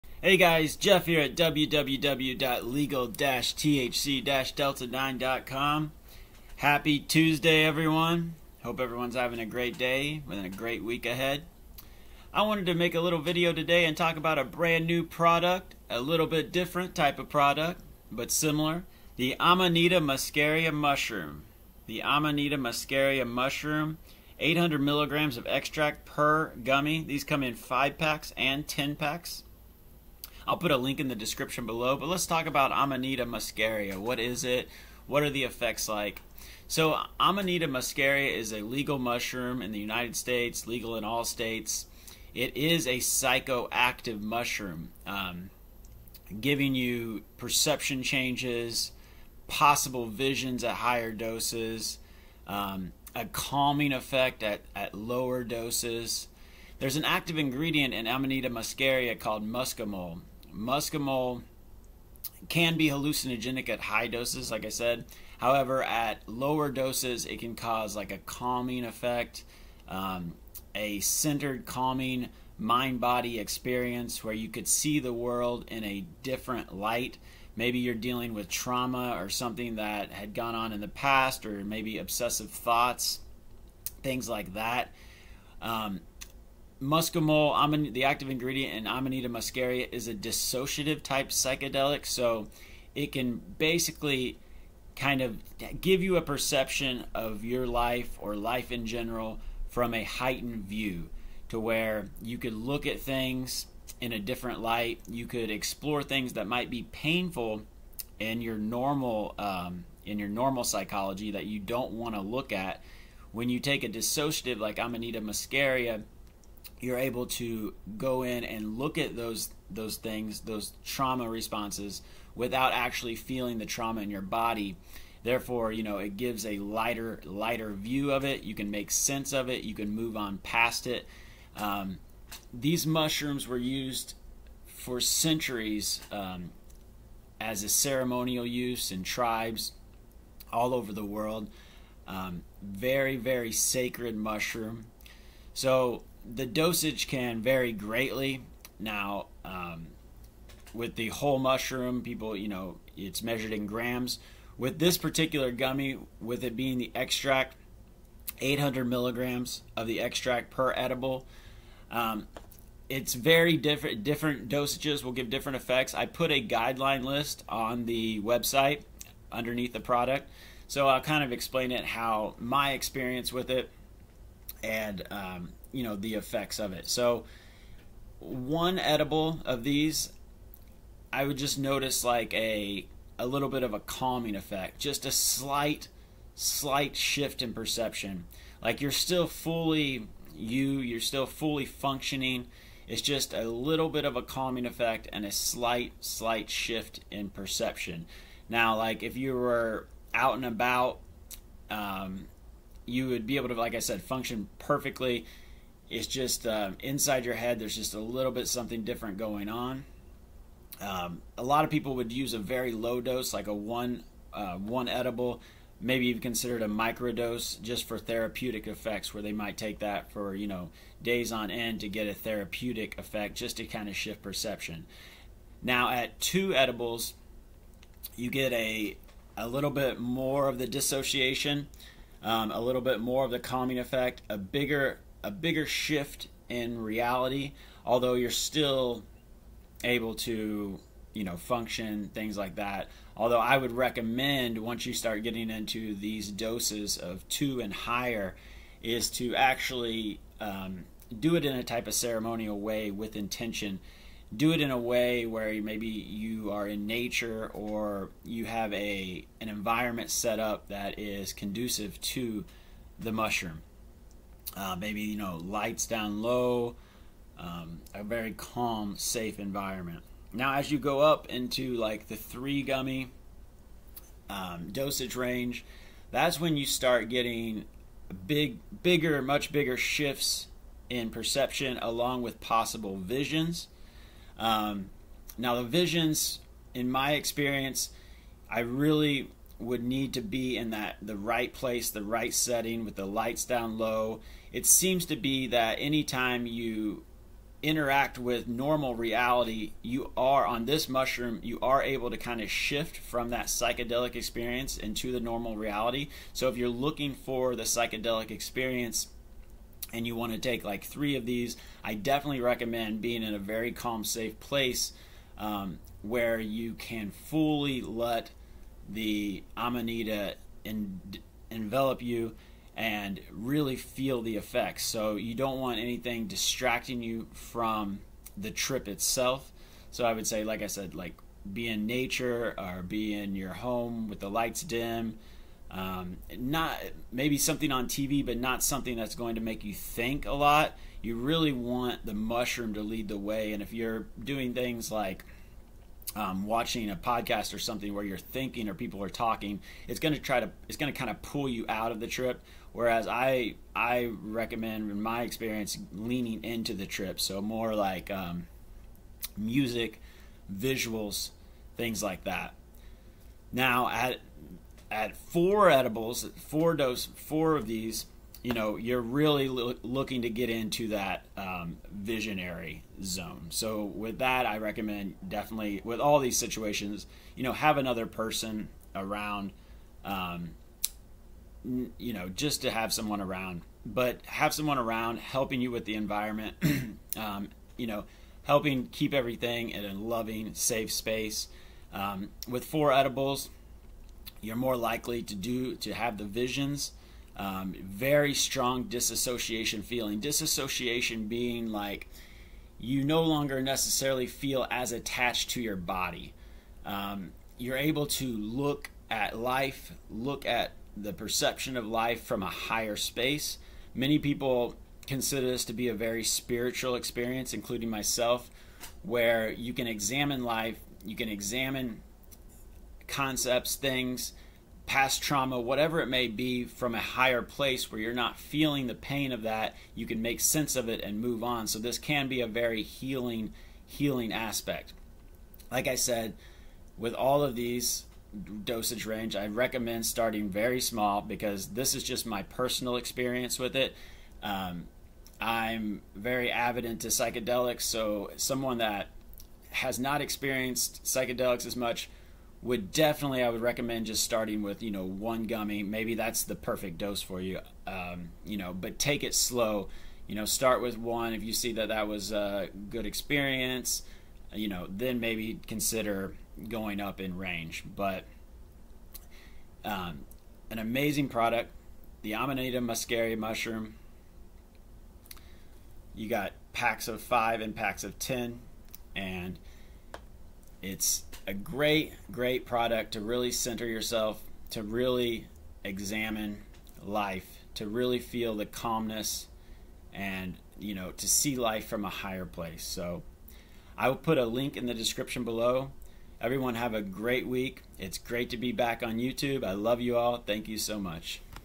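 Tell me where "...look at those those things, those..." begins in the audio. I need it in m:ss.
1:58.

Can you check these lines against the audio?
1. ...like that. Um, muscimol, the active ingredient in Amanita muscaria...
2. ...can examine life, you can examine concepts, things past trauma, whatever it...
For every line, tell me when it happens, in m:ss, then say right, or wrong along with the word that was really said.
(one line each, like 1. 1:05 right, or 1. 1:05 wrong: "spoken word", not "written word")
1. 1:24 right
2. 6:59 right.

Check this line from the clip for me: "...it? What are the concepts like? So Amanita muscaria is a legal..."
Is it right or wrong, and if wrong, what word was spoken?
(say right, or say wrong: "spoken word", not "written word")
wrong: "effects", not "concepts".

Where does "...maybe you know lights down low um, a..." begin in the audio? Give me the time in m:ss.
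4:24.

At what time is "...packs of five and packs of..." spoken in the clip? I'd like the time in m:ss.
7:56.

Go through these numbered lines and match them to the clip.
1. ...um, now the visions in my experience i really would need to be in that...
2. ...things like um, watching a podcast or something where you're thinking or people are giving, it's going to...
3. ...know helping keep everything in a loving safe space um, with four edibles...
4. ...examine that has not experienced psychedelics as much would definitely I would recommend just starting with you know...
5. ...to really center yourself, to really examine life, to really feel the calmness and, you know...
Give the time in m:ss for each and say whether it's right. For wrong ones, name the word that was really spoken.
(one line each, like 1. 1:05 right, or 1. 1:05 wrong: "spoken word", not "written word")
1. 4:44 right
2. 5:44 wrong: "talking", not "giving"
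3. 6:27 right
4. 7:28 wrong: "someone", not "examine"
5. 8:03 right.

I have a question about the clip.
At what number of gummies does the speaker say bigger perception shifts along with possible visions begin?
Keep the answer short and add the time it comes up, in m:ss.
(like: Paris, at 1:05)
3, at 4:32.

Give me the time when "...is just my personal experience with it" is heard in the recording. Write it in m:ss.
7:21.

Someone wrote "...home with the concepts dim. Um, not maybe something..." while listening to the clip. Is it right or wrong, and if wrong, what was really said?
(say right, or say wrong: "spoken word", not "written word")
wrong: "lights", not "concepts".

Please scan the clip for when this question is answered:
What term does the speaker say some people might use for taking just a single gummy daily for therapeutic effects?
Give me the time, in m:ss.
3:36.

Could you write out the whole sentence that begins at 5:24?
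So you don't want anything distracting you from the trip itself.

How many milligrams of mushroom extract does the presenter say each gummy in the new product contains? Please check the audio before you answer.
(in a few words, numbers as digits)
800.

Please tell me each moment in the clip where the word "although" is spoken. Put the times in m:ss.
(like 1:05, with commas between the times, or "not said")
3:57, 4:03.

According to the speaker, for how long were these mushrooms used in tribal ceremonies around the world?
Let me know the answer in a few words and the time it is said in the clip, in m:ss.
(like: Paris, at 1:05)
centuries, at 2:14.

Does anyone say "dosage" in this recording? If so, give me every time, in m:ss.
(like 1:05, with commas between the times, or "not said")
2:26, 2:44, 4:34, 7:18.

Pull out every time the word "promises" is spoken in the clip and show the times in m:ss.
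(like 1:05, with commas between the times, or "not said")
not said.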